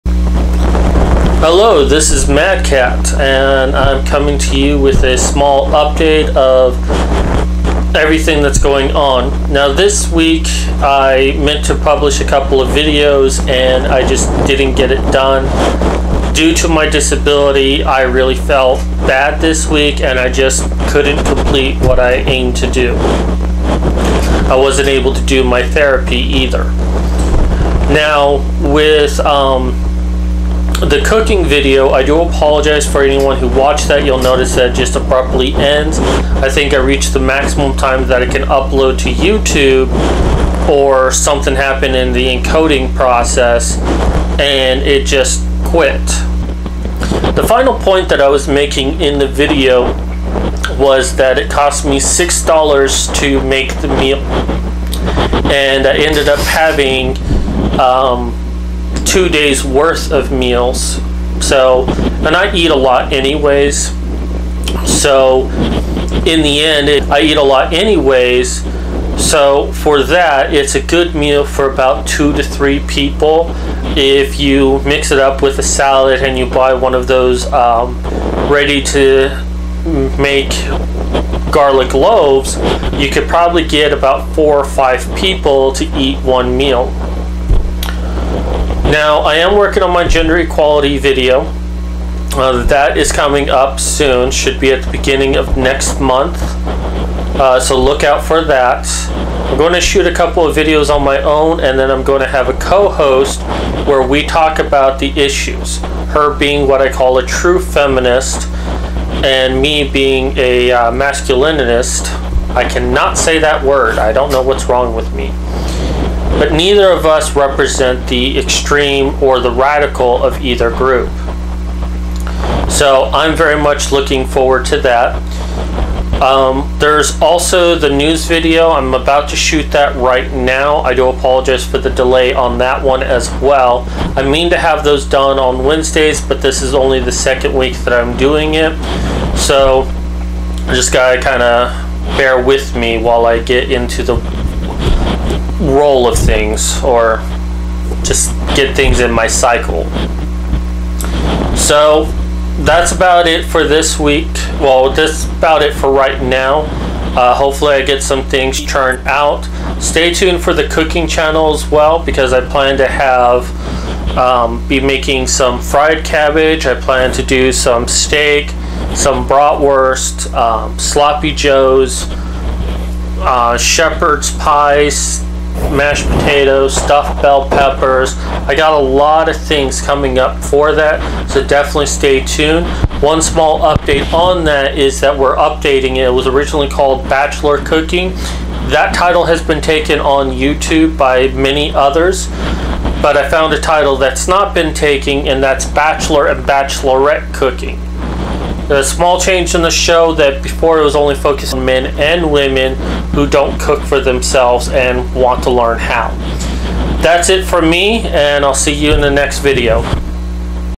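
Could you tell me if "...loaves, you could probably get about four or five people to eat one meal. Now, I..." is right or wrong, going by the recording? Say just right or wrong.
right.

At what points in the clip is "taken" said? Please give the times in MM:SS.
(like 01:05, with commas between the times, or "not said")
03:09, 03:14.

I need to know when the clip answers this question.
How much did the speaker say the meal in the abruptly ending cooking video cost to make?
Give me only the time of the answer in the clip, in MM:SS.
00:51.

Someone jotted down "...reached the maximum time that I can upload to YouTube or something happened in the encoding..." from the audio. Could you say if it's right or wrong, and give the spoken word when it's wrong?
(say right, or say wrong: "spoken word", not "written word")
right.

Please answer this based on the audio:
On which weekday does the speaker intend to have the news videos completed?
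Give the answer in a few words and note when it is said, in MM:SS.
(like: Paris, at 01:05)
Wednesdays, at 02:15.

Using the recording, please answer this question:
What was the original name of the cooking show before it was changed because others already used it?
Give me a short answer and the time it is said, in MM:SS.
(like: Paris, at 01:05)
Bachelor Cooking, at 03:07.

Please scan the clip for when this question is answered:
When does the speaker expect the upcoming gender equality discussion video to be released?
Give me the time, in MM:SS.
01:34.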